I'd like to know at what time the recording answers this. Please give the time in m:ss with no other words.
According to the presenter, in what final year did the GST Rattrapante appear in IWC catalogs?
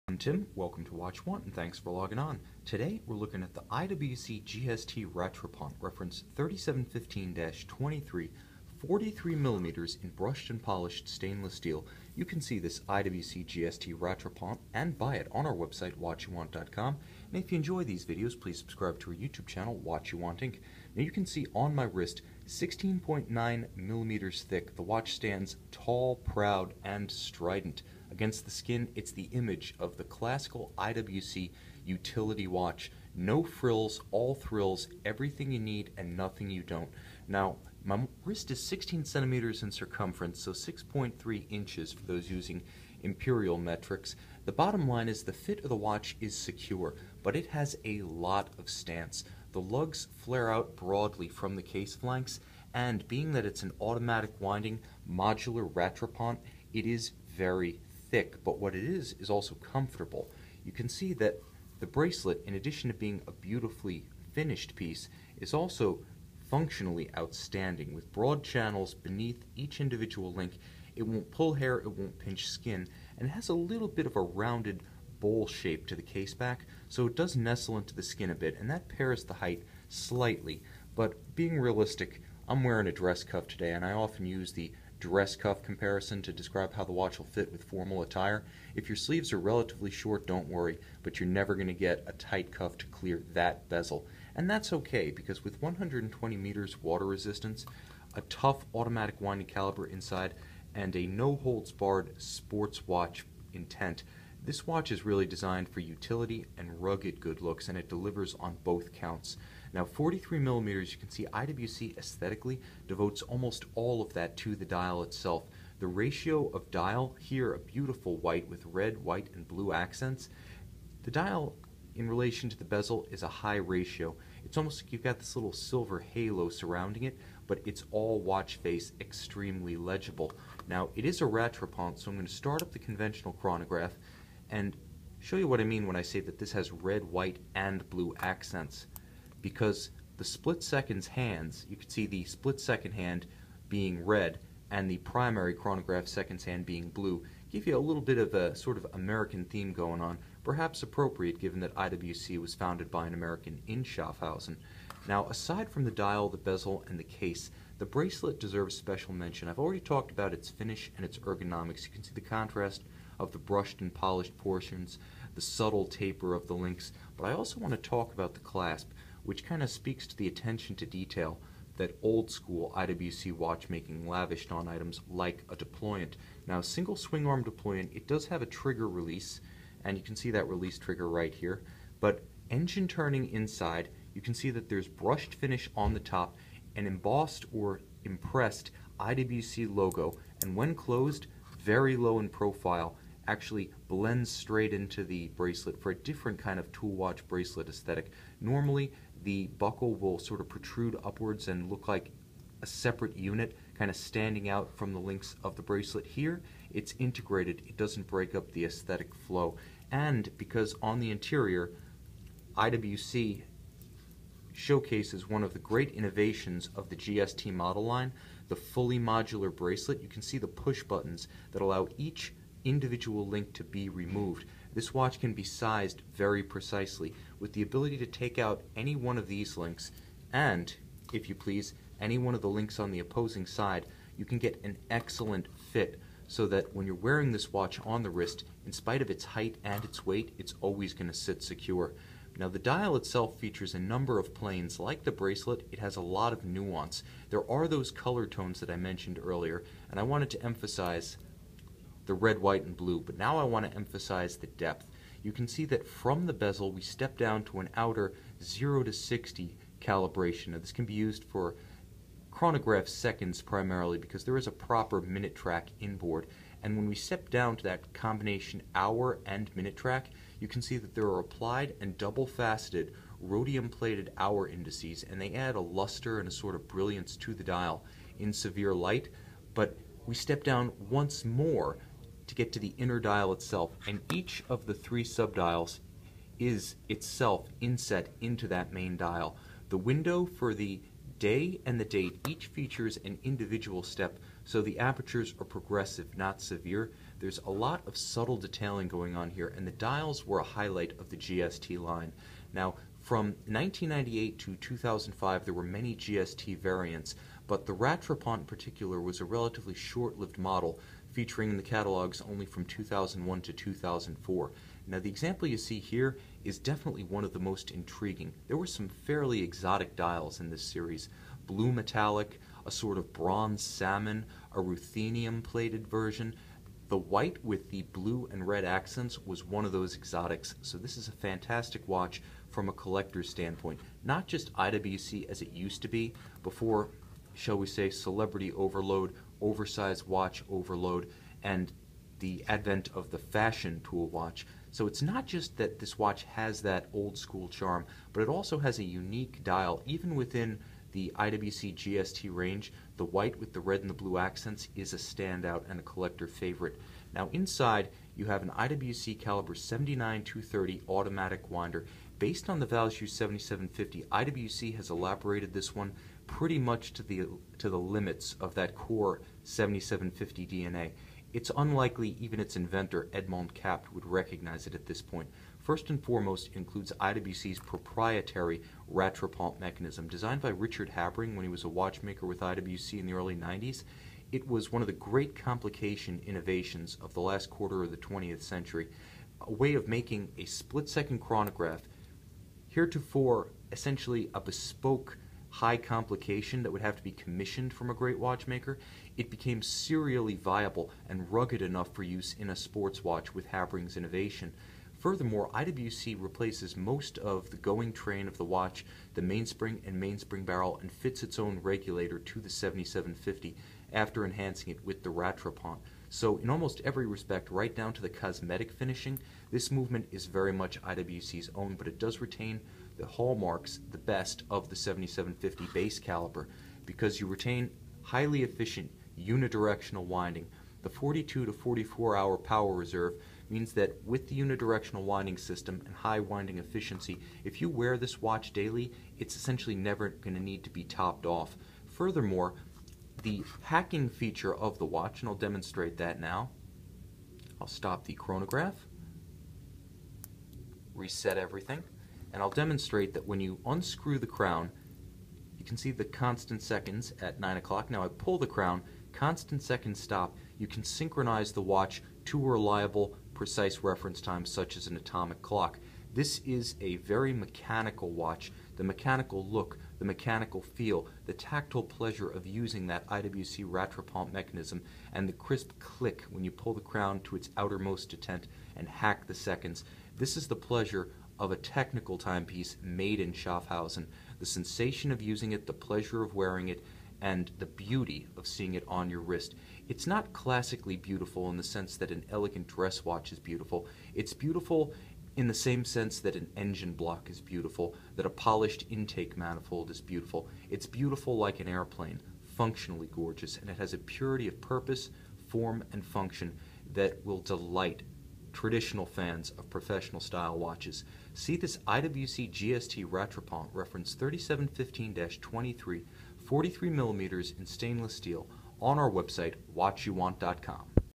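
5:13.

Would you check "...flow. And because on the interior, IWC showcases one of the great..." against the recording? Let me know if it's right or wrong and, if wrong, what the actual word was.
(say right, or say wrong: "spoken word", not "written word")
right.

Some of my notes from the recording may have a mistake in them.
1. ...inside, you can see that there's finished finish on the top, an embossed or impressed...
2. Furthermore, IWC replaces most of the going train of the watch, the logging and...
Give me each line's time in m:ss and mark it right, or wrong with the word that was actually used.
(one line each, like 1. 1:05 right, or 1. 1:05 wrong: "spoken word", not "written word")
1. 3:03 wrong: "brushed", not "finished"
2. 6:44 wrong: "mainspring", not "logging".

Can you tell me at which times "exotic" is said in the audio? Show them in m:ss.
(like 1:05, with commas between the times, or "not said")
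5:19, 5:29.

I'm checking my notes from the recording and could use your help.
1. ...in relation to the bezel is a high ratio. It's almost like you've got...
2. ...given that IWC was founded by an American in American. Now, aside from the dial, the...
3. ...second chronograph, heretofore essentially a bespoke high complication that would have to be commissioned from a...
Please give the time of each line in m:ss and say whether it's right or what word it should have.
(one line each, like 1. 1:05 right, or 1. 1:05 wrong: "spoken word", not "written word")
1. 2:01 right
2. 2:31 wrong: "Schaffhausen", not "American"
3. 6:30 right.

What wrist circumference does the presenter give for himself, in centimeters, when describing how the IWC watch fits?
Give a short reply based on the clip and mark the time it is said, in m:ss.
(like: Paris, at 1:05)
16 centimeters, at 0:38.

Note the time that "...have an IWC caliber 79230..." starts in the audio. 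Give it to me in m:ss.
5:58.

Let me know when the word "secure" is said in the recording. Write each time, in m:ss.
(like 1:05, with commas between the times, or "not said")
0:46, 4:01.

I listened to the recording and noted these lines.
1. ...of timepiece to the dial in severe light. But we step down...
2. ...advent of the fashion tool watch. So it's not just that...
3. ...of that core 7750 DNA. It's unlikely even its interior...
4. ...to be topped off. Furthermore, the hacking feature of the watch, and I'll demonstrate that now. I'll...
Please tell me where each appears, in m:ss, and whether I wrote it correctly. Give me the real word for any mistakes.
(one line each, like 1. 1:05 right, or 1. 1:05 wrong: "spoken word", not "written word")
1. 4:36 wrong: "brilliance", not "timepiece"
2. 5:42 right
3. 6:08 wrong: "inventor", not "interior"
4. 7:20 right.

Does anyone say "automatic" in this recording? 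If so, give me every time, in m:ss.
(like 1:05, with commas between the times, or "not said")
0:53, 1:38, 6:00.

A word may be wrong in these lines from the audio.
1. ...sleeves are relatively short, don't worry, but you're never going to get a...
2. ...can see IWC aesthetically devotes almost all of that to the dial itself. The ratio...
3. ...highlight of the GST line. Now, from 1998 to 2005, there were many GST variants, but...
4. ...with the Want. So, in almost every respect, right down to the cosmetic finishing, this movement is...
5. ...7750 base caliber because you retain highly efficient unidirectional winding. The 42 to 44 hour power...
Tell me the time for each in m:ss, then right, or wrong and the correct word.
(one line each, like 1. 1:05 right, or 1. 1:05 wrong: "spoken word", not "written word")
1. 1:28 right
2. 1:50 right
3. 5:00 right
4. 6:54 wrong: "Rattrapante", not "Want"
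5. 7:04 right.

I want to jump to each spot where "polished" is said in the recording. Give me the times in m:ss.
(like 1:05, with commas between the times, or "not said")
0:10, 2:43, 8:18.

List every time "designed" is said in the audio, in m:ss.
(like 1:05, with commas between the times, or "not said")
1:45, 6:20.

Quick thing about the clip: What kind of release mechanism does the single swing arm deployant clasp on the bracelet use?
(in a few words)
Trigger release.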